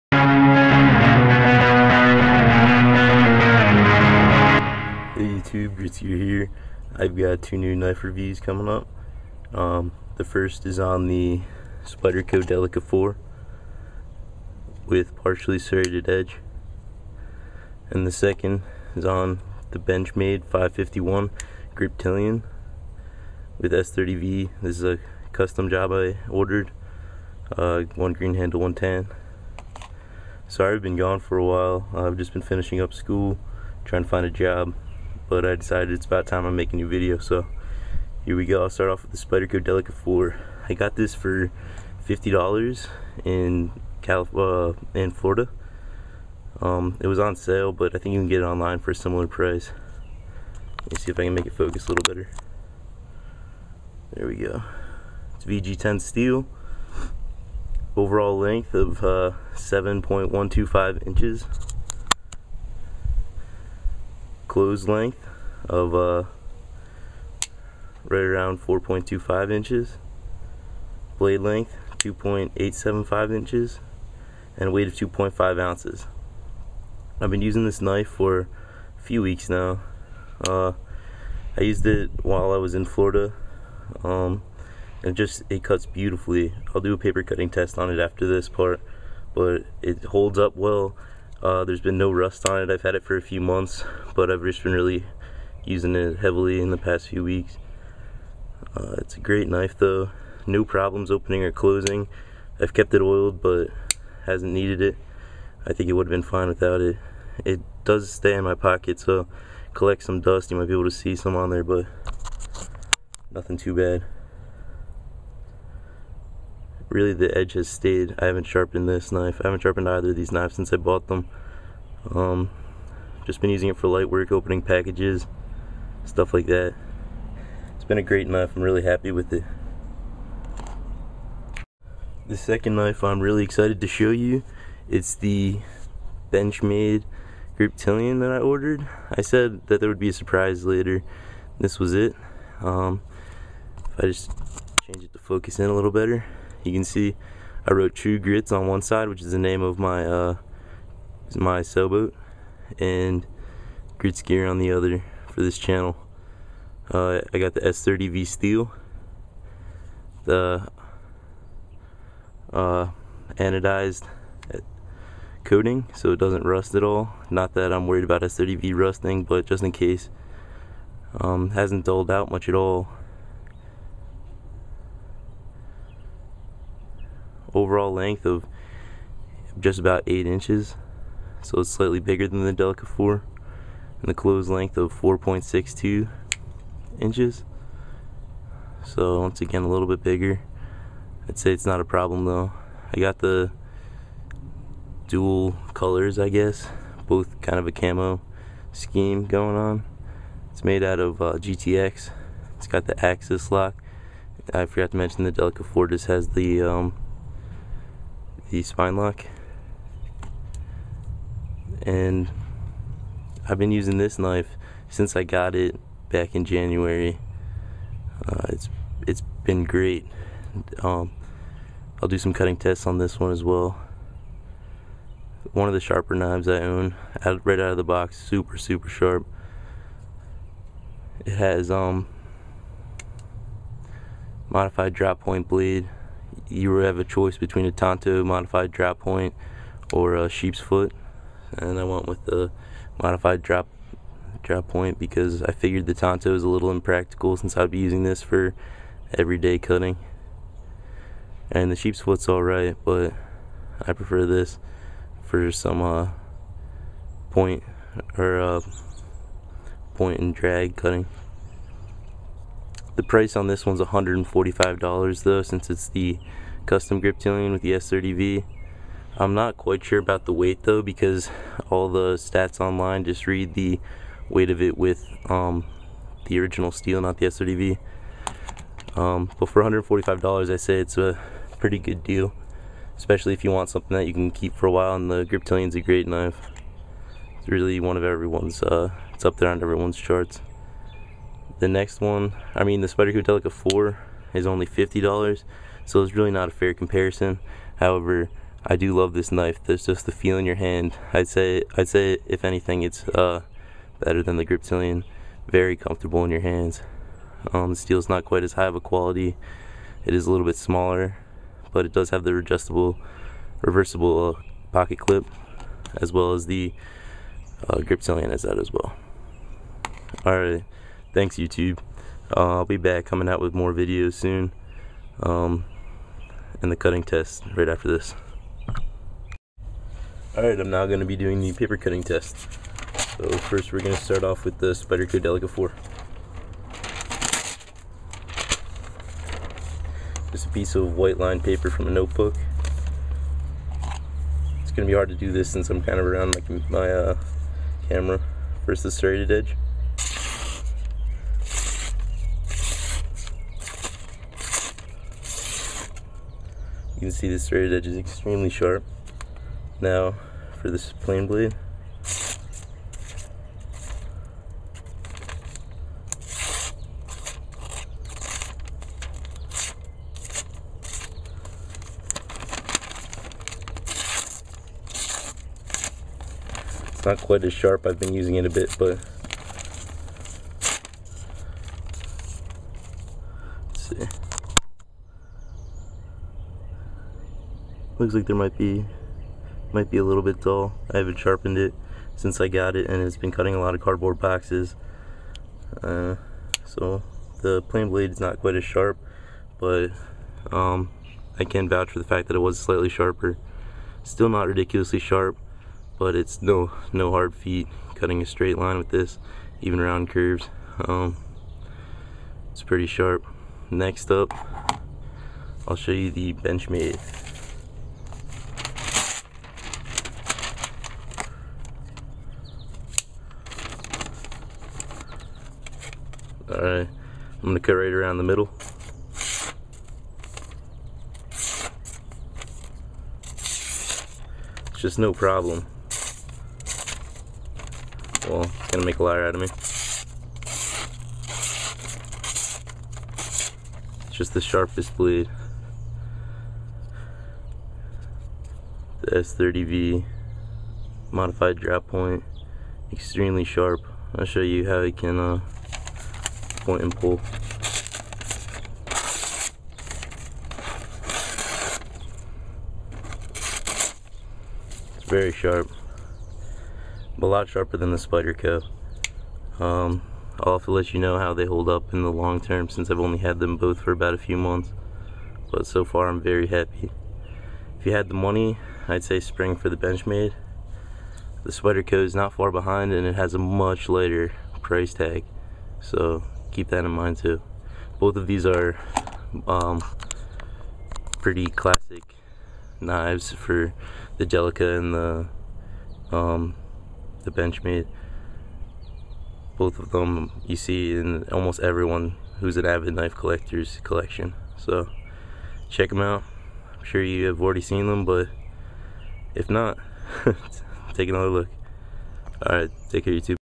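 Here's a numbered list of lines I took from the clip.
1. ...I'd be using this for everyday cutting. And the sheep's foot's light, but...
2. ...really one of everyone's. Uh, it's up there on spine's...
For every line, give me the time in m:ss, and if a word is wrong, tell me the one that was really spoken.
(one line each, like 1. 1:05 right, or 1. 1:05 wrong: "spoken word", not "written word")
1. 4:07 wrong: "alright", not "light"
2. 4:47 wrong: "everyone", not "spine".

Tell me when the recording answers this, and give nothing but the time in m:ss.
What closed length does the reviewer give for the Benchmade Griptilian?
3:04.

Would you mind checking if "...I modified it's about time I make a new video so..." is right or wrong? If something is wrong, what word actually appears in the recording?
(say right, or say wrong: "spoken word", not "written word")
wrong: "decided", not "modified".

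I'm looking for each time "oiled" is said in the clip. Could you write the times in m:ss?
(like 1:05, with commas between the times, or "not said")
1:43.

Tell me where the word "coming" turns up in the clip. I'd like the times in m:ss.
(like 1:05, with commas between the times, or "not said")
0:08, 5:23.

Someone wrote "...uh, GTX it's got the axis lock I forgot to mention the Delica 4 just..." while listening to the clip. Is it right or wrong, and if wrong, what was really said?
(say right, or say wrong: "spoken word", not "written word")
right.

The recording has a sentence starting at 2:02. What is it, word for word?
Um, just been using it for light work, opening packages, stuff like that.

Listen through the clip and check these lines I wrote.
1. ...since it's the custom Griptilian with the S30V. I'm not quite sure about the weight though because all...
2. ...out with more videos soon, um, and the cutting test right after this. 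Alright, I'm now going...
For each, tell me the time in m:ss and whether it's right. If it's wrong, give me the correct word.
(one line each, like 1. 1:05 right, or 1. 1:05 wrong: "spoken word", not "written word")
1. 4:25 right
2. 5:23 right.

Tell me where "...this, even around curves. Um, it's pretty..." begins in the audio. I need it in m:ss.
6:48.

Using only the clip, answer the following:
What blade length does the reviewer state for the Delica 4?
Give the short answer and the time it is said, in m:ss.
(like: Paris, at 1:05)
2.875 inches, at 1:11.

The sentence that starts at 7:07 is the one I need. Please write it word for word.
gonna cut right around the middle.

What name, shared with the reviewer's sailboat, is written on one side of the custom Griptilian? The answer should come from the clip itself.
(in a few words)
True Grits.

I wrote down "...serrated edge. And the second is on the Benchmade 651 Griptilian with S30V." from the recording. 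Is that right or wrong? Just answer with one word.
wrong.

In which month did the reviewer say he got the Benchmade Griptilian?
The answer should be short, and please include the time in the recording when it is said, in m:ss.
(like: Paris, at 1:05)
January, at 3:36.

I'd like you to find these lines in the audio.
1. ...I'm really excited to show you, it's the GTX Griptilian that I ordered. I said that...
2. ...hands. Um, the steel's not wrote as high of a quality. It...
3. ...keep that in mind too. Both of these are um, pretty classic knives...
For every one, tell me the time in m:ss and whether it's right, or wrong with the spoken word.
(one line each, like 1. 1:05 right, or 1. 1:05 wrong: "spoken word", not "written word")
1. 2:13 wrong: "Benchmade", not "GTX"
2. 5:06 wrong: "quite", not "wrote"
3. 8:06 right.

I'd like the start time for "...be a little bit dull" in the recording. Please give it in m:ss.
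6:29.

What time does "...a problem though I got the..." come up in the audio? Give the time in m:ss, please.
3:11.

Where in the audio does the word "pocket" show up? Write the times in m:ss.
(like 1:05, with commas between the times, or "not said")
1:48, 5:14.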